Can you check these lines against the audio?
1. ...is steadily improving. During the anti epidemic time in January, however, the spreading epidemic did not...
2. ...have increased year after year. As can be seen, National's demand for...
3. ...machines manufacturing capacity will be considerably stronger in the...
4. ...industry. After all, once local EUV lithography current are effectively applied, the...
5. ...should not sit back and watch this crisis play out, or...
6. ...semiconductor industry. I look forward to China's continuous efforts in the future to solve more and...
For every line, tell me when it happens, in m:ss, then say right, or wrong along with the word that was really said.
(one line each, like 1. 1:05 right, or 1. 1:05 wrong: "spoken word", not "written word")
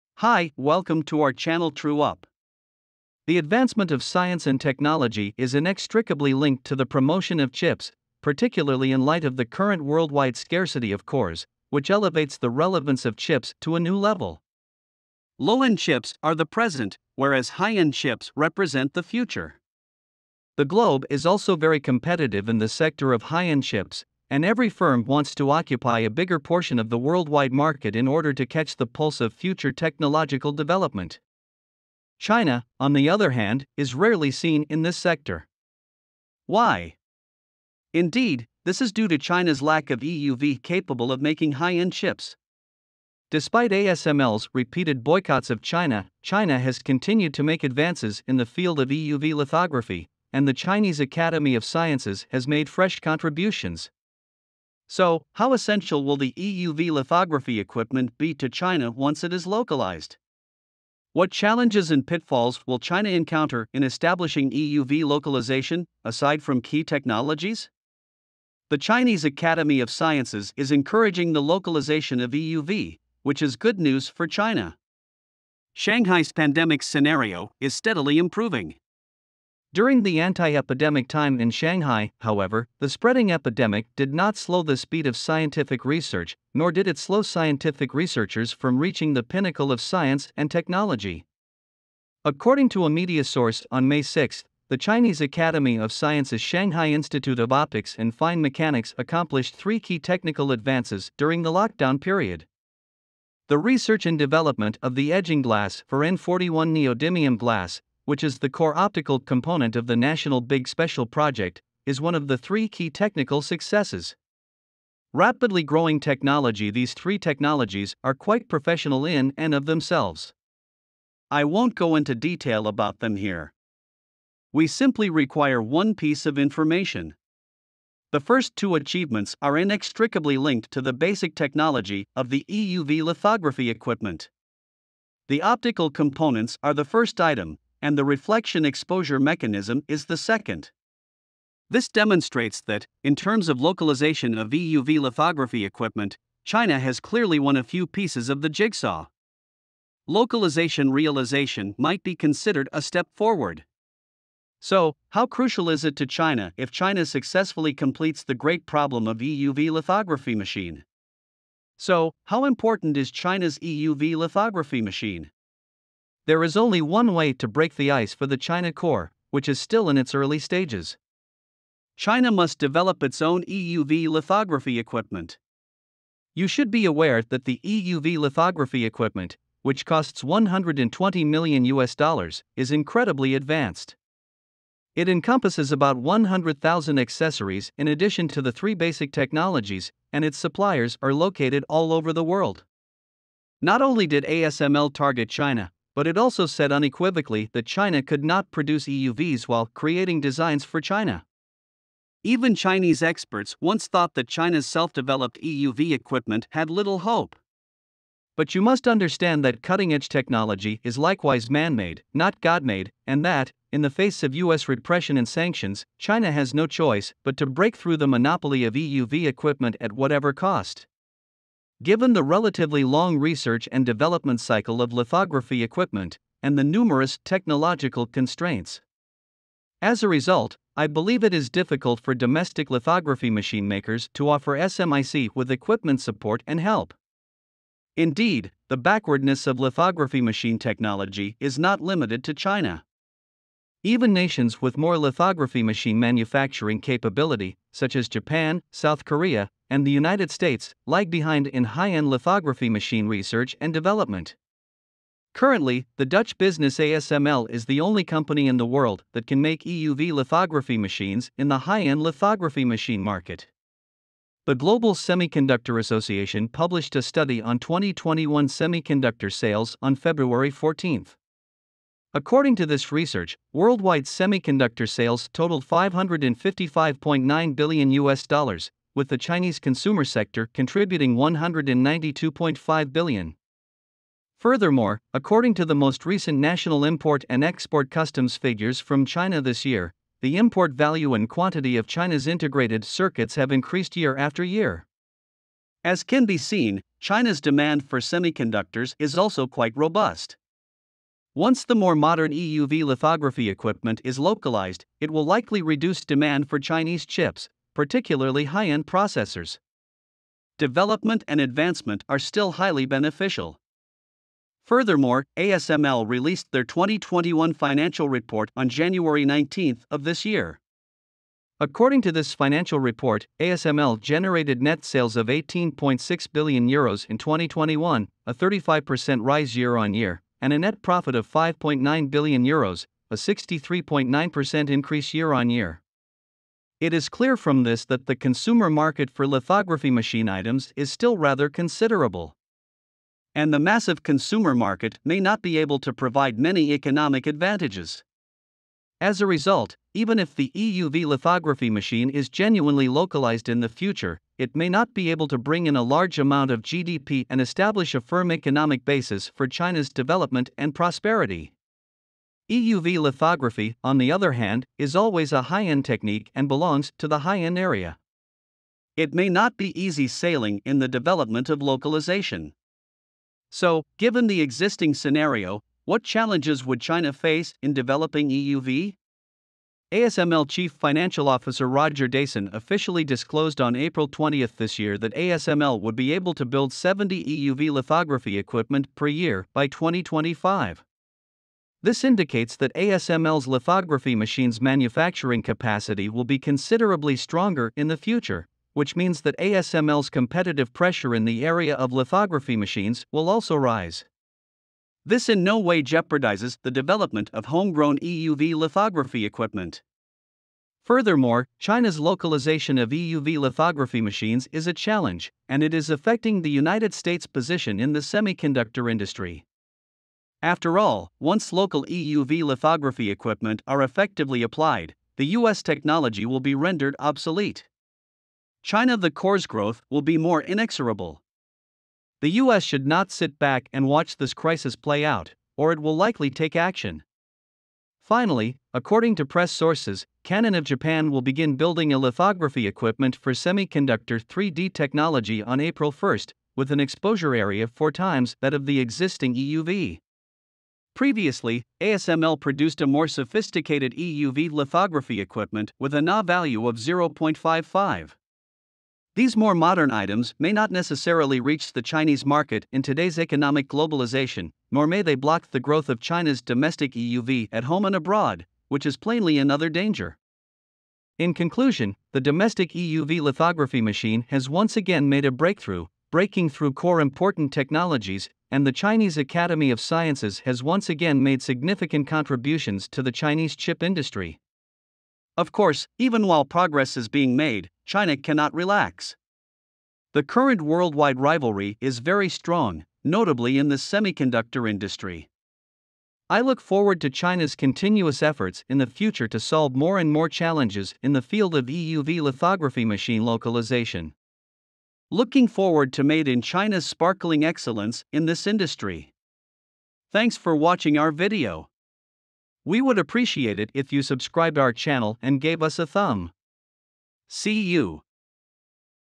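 1. 1:17 wrong: "Shanghai", not "January"
2. 4:53 wrong: "China", not "National"
3. 6:34 right
4. 6:58 wrong: "equipment", not "current"
5. 7:12 right
6. 8:13 right.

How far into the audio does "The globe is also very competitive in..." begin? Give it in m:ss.
0:20.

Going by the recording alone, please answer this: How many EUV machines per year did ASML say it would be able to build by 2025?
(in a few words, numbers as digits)
70.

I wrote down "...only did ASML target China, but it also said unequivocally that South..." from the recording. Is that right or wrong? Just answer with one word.
wrong.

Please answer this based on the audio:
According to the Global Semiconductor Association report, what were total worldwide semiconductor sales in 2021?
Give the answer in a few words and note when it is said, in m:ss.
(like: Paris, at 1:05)
555.9 billion US dollars, at 4:35.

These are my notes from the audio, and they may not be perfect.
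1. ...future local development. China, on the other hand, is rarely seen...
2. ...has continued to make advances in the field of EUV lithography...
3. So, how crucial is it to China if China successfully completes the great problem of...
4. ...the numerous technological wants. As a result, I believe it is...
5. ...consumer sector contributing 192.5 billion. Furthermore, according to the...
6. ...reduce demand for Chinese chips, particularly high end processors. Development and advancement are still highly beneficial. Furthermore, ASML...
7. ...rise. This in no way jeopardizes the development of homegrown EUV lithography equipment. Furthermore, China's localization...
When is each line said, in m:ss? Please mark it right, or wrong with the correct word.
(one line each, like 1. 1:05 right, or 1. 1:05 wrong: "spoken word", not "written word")
1. 0:29 wrong: "technological", not "local"
2. 0:46 right
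3. 2:34 right
4. 3:46 wrong: "constraints", not "wants"
5. 4:39 right
6. 5:05 right
7. 6:43 right.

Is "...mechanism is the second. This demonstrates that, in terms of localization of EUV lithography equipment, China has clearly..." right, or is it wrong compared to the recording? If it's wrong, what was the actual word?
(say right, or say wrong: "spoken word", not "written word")
right.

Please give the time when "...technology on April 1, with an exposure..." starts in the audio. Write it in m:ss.
7:24.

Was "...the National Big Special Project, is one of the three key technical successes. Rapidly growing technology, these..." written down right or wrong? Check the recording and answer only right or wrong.
right.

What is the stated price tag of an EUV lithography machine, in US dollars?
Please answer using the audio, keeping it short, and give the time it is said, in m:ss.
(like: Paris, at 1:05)
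120 million US dollars, at 3:00.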